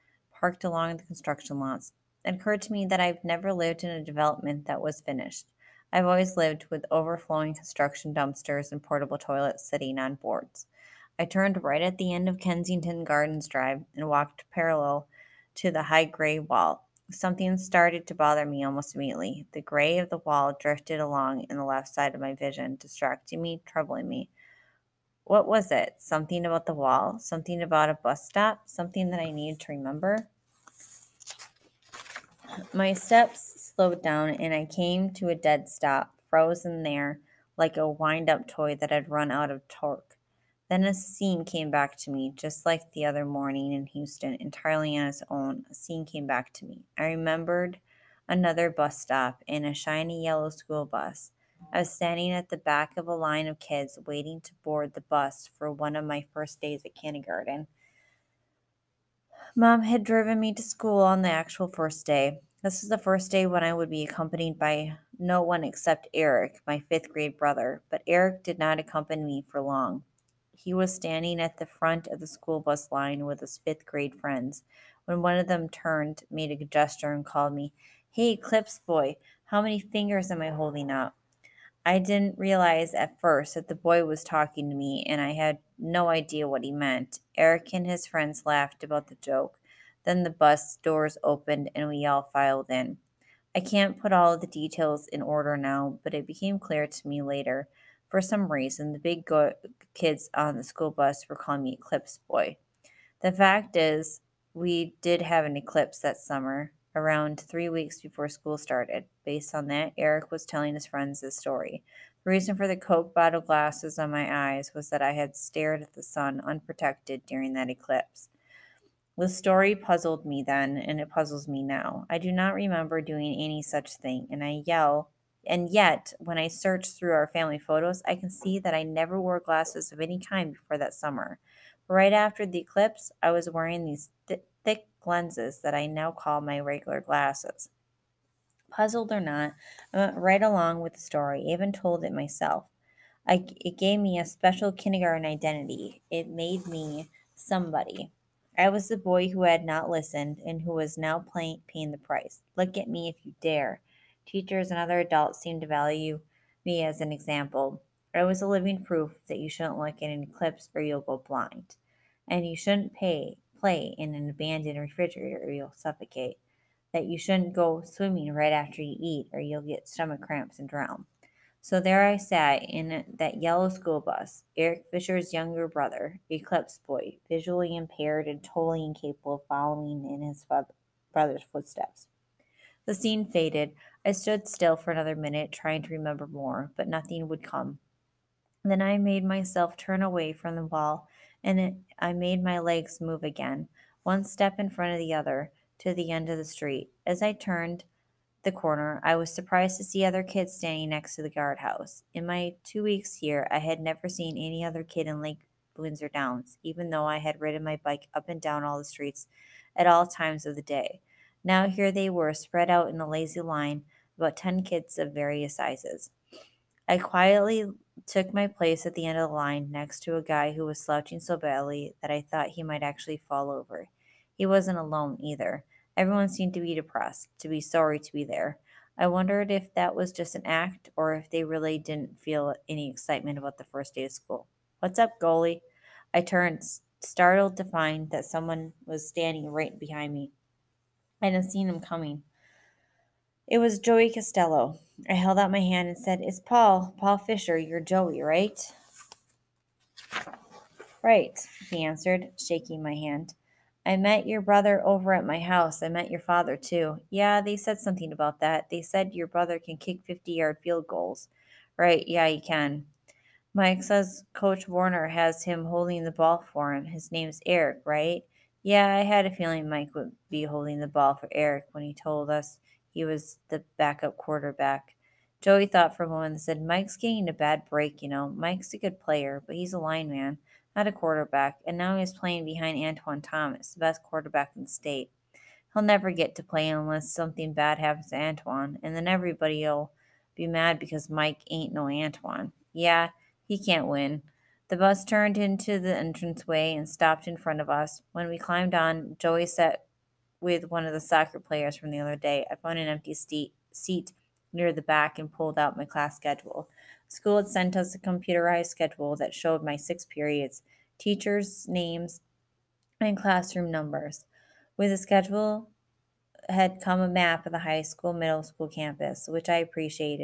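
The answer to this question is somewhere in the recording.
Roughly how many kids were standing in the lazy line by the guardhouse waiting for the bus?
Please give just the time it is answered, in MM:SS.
03:34.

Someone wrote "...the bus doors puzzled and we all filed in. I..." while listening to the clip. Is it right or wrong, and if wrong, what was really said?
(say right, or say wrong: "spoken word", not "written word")
wrong: "opened", not "puzzled".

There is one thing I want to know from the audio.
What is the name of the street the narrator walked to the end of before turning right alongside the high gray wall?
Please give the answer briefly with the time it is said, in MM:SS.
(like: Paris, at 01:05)
Kensington Gardens Drive, at 00:12.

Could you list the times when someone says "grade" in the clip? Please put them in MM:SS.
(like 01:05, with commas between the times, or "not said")
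01:07, 01:13.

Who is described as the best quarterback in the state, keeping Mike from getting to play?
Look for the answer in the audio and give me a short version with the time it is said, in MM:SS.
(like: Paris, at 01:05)
Antoine Thomas, at 04:42.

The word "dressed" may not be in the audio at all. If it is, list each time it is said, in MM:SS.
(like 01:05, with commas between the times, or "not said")
not said.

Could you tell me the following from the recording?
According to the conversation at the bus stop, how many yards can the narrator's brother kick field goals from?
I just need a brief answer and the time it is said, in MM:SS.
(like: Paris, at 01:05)
50, at 04:20.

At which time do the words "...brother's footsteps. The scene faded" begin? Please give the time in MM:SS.
03:01.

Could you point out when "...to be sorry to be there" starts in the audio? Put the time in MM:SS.
03:47.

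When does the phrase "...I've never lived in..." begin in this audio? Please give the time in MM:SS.
00:03.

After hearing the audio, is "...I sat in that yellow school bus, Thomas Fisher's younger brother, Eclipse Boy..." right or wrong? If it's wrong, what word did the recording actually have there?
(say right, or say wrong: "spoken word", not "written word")
wrong: "Eric", not "Thomas".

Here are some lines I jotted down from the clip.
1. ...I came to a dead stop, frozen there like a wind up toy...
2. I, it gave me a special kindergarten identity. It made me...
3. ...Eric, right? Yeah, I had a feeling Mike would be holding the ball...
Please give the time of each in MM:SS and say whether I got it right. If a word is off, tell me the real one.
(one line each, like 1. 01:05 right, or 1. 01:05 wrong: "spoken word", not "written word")
1. 00:34 right
2. 02:23 right
3. 04:27 right.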